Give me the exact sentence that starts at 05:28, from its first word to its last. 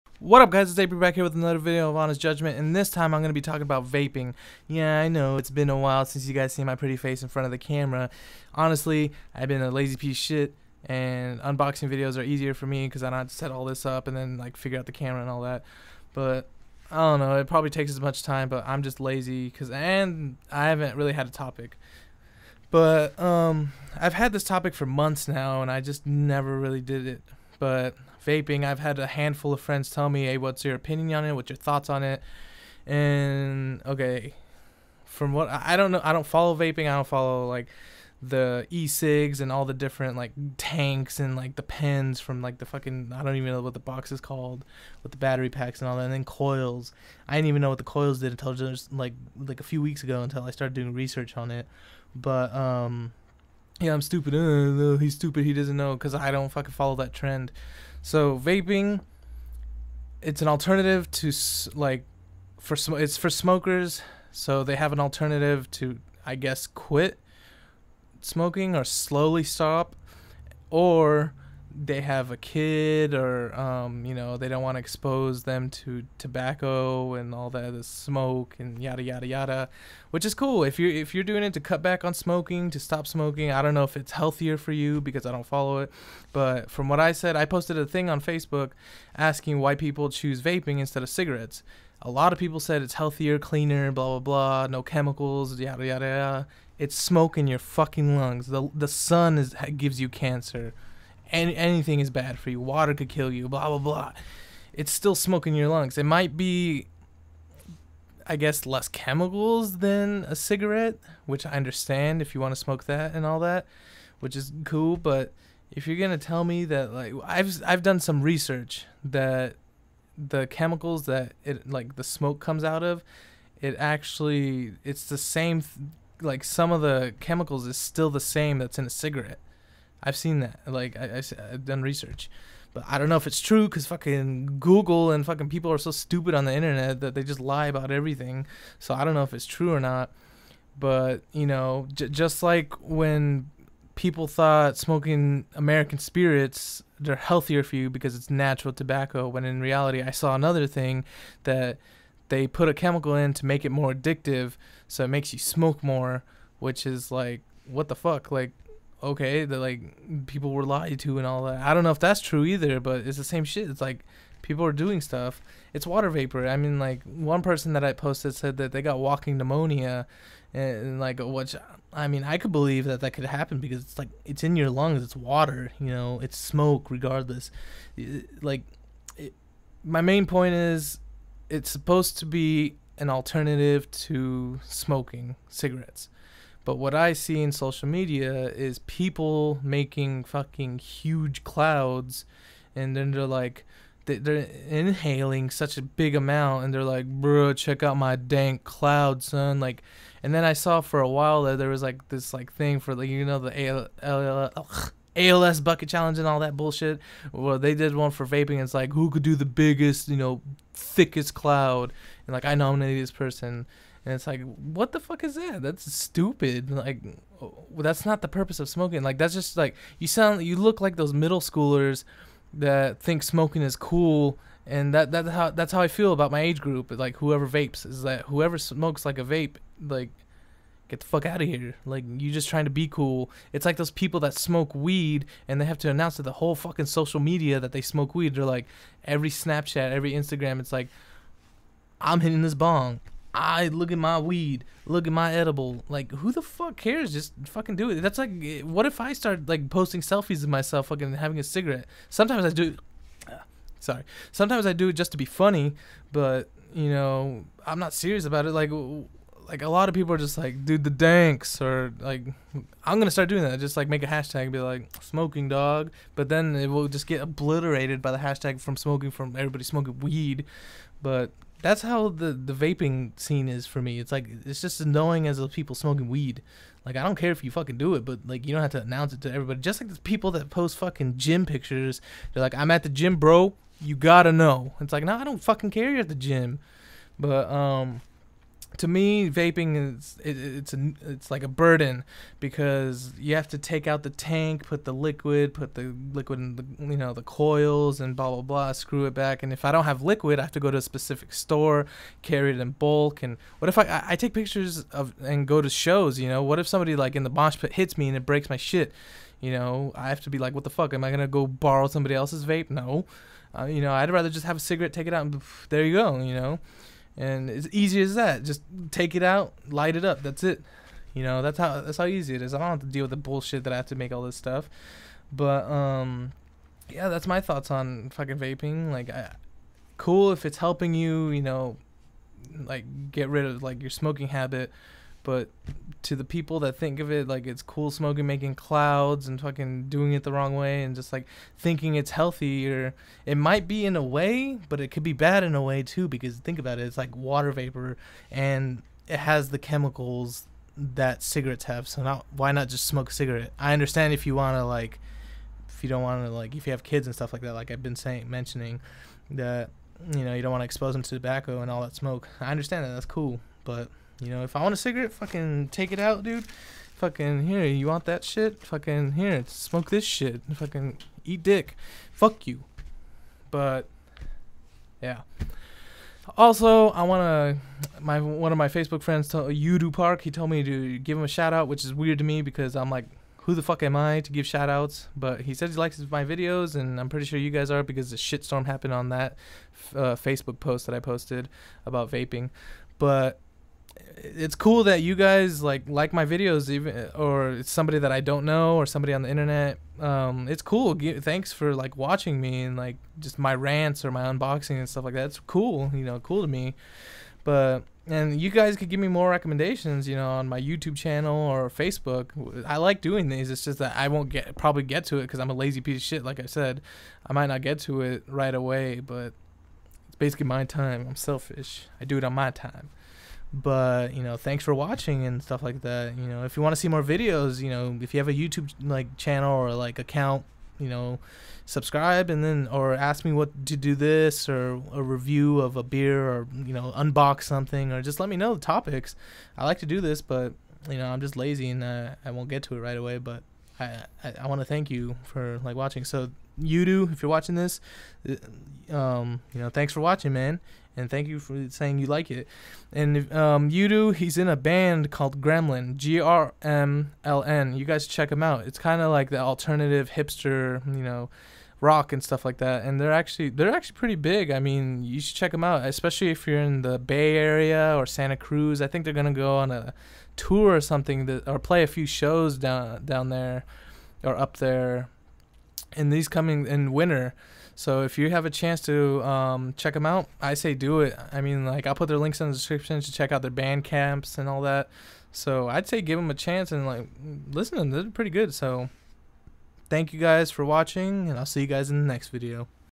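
Like, I, cool if it's helping you.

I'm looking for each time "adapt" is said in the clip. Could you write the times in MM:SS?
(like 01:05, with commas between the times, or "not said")
not said.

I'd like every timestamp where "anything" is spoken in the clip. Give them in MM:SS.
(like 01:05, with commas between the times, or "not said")
01:41.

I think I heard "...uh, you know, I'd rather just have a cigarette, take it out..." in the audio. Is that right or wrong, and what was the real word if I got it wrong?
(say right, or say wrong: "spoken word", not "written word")
right.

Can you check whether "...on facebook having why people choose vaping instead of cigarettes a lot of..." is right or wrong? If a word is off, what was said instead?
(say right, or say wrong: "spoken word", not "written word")
wrong: "asking", not "having".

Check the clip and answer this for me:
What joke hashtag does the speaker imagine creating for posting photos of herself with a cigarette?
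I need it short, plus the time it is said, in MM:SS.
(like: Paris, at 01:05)
smoking dog, at 04:25.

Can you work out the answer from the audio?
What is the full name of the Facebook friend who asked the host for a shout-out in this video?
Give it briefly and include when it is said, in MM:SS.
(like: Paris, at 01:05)
Yoodoo Park, at 06:19.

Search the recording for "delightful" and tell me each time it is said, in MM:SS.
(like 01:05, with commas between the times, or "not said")
not said.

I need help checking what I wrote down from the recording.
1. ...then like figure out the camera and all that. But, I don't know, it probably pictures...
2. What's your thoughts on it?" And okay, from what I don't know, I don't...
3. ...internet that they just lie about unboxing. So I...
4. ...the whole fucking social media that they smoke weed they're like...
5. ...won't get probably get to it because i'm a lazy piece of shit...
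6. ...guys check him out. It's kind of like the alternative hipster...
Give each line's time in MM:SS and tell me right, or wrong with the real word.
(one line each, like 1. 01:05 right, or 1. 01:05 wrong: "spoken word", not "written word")
1. 00:14 wrong: "takes", not "pictures"
2. 00:31 right
3. 02:16 wrong: "everything", not "unboxing"
4. 03:56 right
5. 06:54 right
6. 07:37 right.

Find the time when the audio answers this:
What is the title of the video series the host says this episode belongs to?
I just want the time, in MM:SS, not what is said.
00:01.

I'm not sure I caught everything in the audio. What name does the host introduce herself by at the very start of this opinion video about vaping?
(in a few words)
April.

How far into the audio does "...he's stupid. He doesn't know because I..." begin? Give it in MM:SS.
00:54.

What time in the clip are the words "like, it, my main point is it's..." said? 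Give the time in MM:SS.
02:58.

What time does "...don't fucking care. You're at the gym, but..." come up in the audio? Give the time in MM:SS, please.
04:45.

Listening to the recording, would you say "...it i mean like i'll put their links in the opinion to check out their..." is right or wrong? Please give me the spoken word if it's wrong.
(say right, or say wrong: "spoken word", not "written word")
wrong: "description", not "opinion".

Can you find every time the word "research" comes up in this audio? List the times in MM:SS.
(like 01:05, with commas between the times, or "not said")
00:50, 01:58, 02:11.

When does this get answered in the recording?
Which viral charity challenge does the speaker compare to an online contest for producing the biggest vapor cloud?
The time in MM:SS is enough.
03:25.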